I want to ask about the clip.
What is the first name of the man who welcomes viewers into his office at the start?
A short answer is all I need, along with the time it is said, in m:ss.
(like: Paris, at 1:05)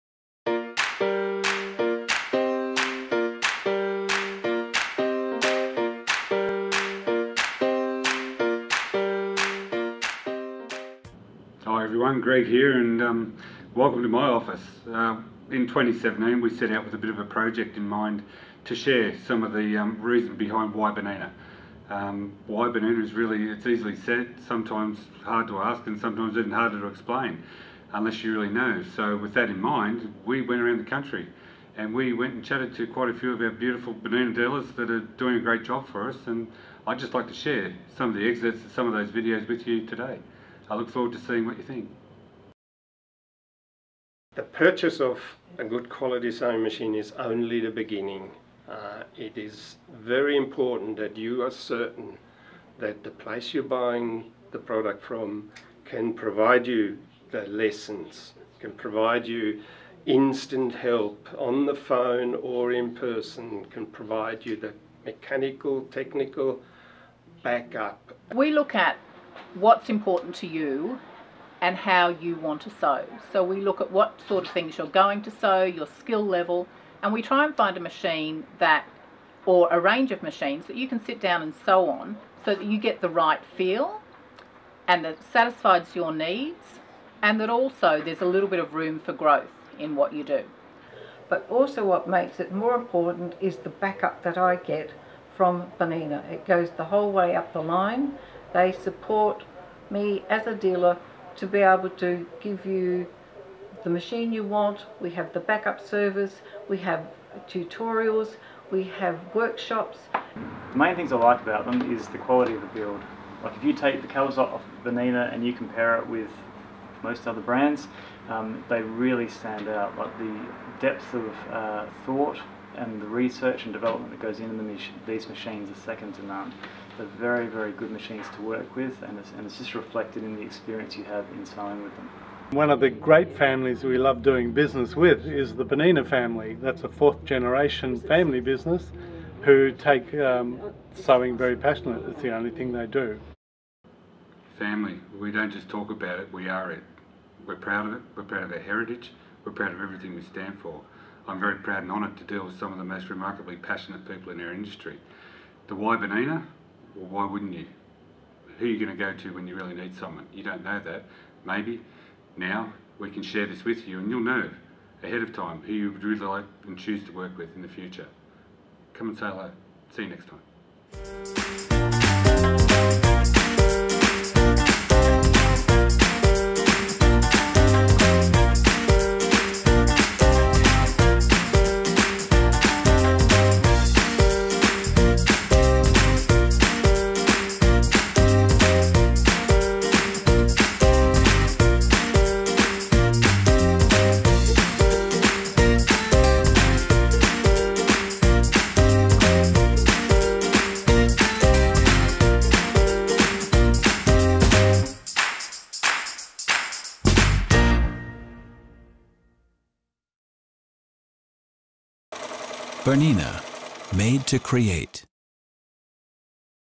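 Greg, at 0:12.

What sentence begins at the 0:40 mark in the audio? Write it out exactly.
I look forward to seeing what you think.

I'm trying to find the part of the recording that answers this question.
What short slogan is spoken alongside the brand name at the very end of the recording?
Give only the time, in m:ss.
3:33.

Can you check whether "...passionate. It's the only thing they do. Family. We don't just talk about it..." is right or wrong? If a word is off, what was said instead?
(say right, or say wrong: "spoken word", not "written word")
right.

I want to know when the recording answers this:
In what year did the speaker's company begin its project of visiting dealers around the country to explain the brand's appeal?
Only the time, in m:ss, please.
0:15.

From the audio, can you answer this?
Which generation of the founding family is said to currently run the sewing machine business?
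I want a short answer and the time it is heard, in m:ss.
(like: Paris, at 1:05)
Fourth, at 2:16.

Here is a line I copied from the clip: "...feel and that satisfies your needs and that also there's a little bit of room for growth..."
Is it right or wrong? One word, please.
right.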